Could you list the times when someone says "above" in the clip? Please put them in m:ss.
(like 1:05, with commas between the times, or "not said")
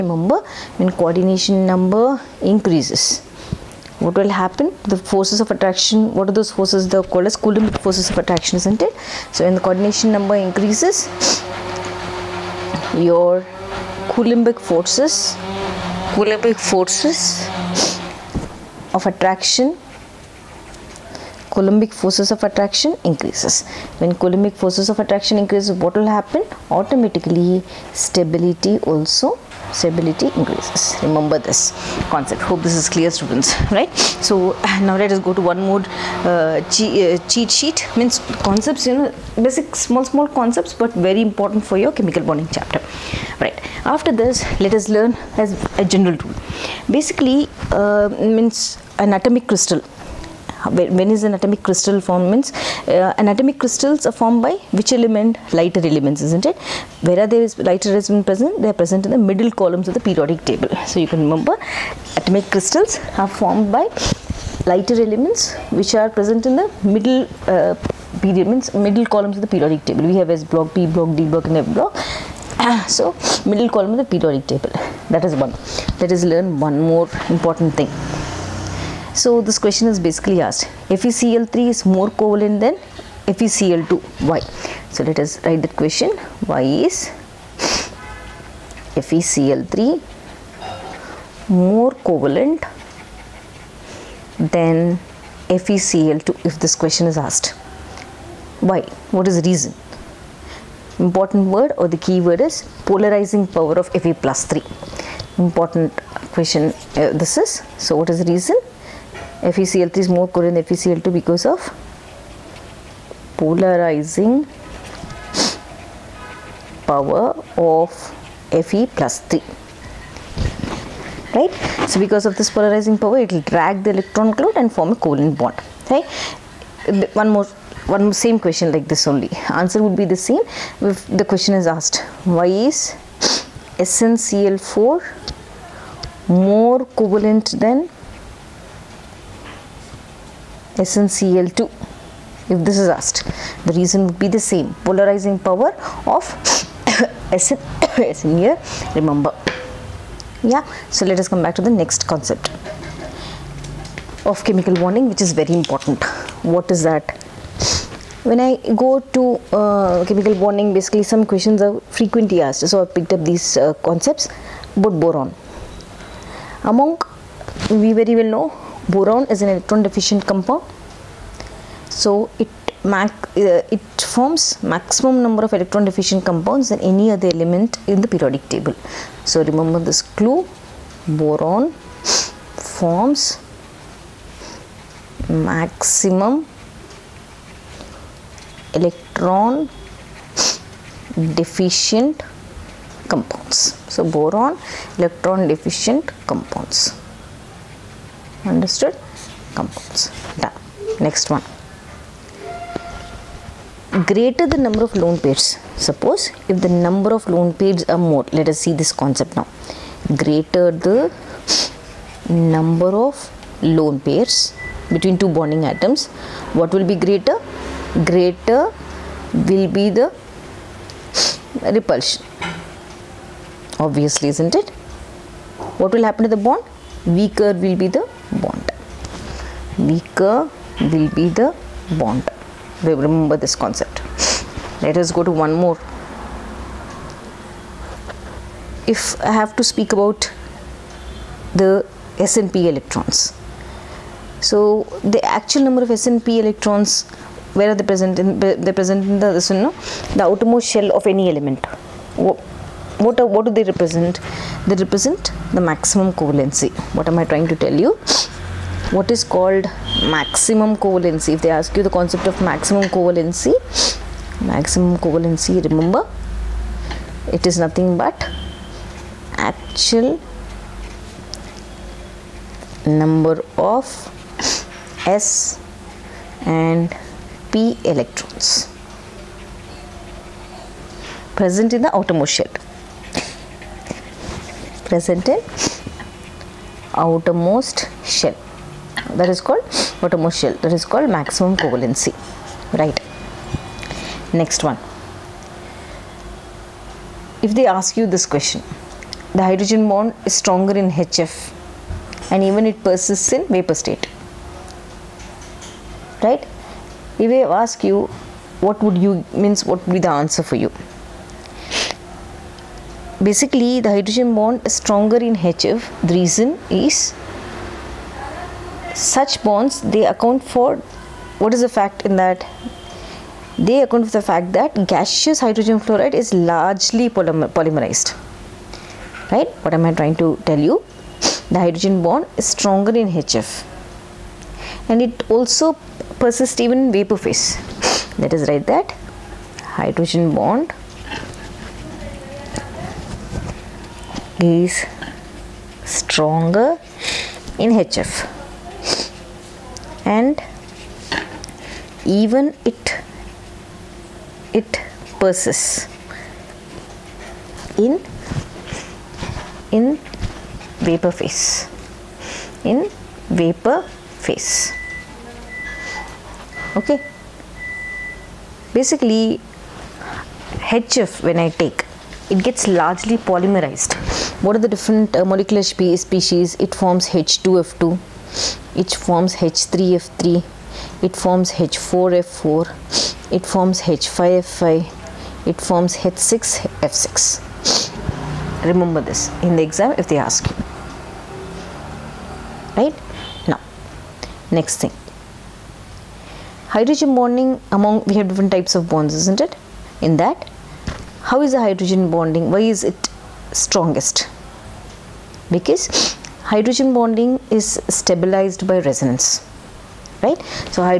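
not said.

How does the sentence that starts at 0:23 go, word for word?
When coulombic forces of attraction increases, what will happen?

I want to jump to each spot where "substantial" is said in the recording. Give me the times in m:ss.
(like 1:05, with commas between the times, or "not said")
not said.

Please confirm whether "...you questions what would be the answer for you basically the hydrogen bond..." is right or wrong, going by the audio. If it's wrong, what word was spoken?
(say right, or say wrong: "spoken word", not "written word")
wrong: "means", not "questions".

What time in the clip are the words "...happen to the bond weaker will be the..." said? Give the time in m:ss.
3:46.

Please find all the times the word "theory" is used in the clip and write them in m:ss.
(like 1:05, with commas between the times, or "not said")
not said.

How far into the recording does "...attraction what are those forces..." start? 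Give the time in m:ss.
0:05.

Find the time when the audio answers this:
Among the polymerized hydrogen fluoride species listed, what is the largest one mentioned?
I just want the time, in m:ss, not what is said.
6:25.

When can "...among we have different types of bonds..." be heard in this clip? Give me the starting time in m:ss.
6:37.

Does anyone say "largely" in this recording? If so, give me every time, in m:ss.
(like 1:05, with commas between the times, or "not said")
5:26, 6:12.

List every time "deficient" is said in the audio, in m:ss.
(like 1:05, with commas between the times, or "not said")
2:49, 2:55, 3:11, 3:15.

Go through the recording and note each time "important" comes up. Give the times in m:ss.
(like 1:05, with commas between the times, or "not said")
0:41, 1:17, 1:40, 1:45, 2:35.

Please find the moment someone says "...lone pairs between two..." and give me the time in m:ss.
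3:33.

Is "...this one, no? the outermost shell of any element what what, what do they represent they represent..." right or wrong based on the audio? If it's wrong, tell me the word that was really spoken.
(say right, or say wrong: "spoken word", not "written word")
right.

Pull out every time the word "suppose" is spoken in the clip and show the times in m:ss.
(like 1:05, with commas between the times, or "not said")
3:25.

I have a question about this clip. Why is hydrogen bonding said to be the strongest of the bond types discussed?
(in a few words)
Stabilized by resonance.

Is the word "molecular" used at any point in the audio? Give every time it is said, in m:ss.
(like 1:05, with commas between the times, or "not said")
6:15.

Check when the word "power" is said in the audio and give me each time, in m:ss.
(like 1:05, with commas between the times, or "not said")
1:43, 1:56, 2:02, 2:25.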